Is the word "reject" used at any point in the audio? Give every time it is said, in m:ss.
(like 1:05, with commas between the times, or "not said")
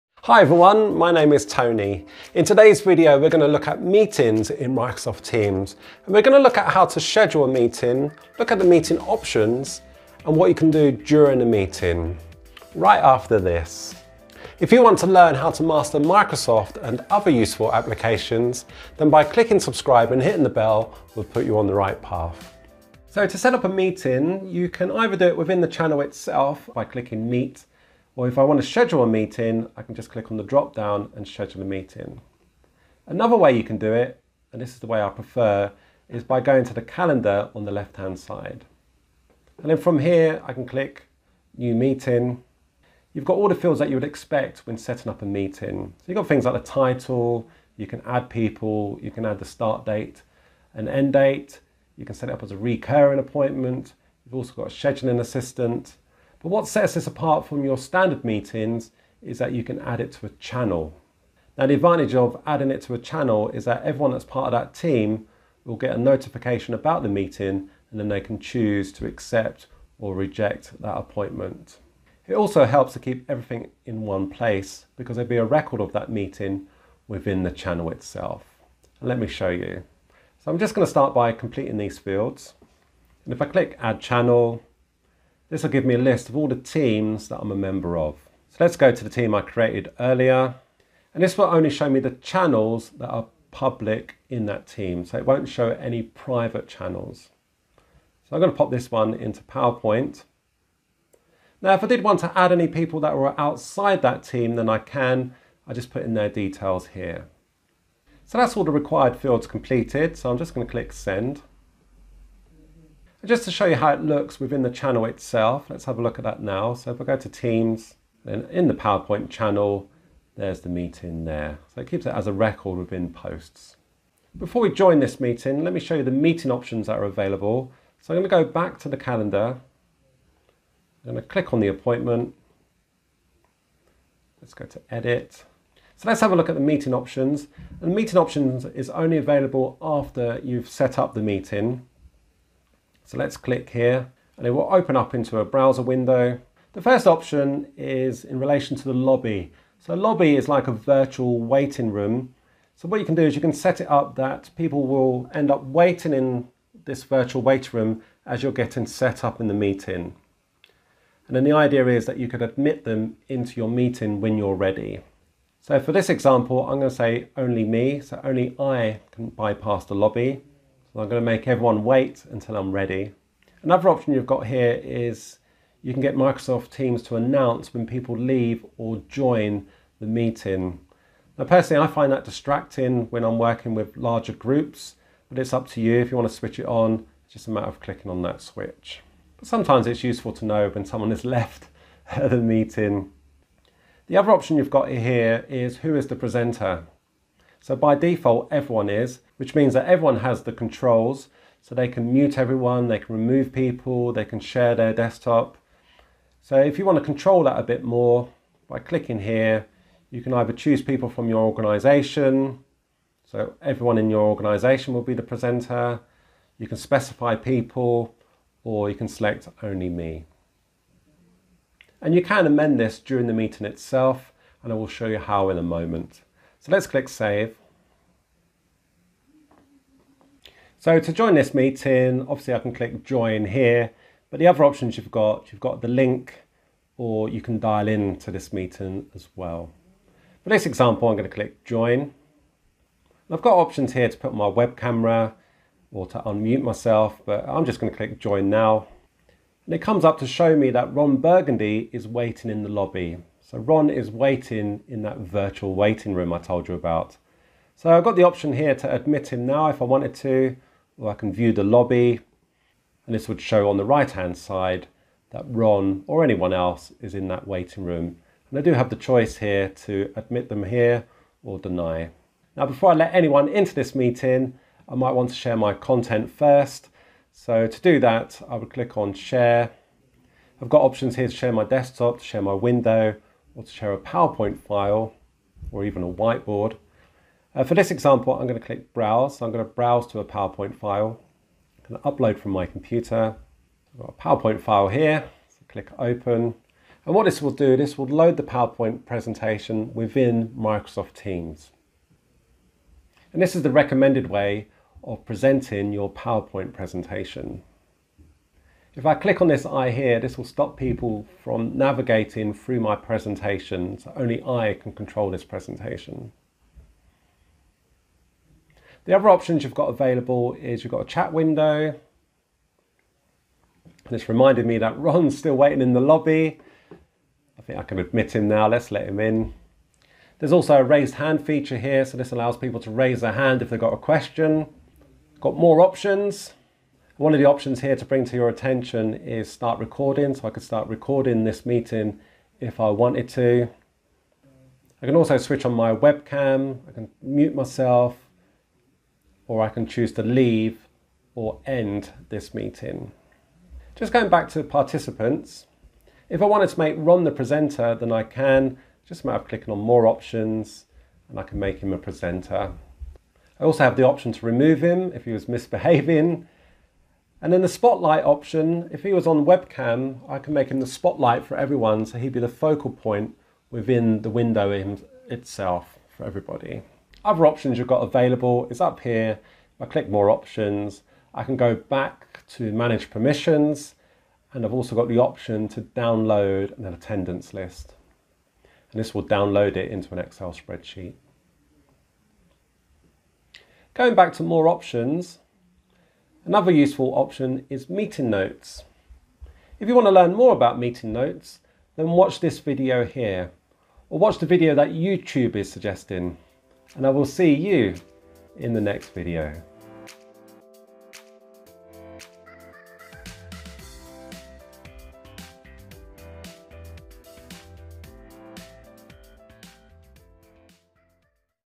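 1:10.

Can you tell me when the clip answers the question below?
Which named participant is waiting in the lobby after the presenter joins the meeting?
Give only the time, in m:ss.
4:10.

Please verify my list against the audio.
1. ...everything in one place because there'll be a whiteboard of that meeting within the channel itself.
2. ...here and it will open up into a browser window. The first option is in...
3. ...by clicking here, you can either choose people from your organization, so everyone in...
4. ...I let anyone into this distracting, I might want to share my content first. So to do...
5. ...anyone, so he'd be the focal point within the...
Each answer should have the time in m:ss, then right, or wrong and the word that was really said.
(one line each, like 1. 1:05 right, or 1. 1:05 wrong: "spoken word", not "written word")
1. 1:13 wrong: "record", not "whiteboard"
2. 2:23 right
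3. 3:28 right
4. 4:32 wrong: "meeting", not "distracting"
5. 6:11 wrong: "everyone", not "anyone".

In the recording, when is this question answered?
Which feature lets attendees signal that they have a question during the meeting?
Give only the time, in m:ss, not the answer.
5:30.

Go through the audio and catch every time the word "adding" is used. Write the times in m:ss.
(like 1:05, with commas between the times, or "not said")
1:02.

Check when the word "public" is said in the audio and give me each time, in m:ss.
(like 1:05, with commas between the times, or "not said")
1:33.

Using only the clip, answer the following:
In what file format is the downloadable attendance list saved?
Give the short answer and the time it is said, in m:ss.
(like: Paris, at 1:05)
Excel spreadsheet, at 6:30.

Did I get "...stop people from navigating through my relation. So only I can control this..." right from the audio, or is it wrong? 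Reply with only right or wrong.
wrong.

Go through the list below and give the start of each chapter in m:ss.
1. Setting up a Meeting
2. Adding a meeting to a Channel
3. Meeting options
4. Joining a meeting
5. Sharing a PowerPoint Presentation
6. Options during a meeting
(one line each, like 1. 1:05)
1. 0:24
2. 0:57
3. 2:04
4. 3:51
5. 4:35
6. 5:19.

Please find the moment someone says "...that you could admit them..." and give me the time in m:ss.
2:42.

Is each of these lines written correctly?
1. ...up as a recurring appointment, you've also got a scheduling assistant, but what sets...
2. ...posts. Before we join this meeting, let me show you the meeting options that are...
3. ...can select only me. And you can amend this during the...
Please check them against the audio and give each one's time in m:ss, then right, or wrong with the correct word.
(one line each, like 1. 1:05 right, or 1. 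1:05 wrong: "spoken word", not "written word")
1. 0:52 right
2. 2:03 right
3. 3:38 right.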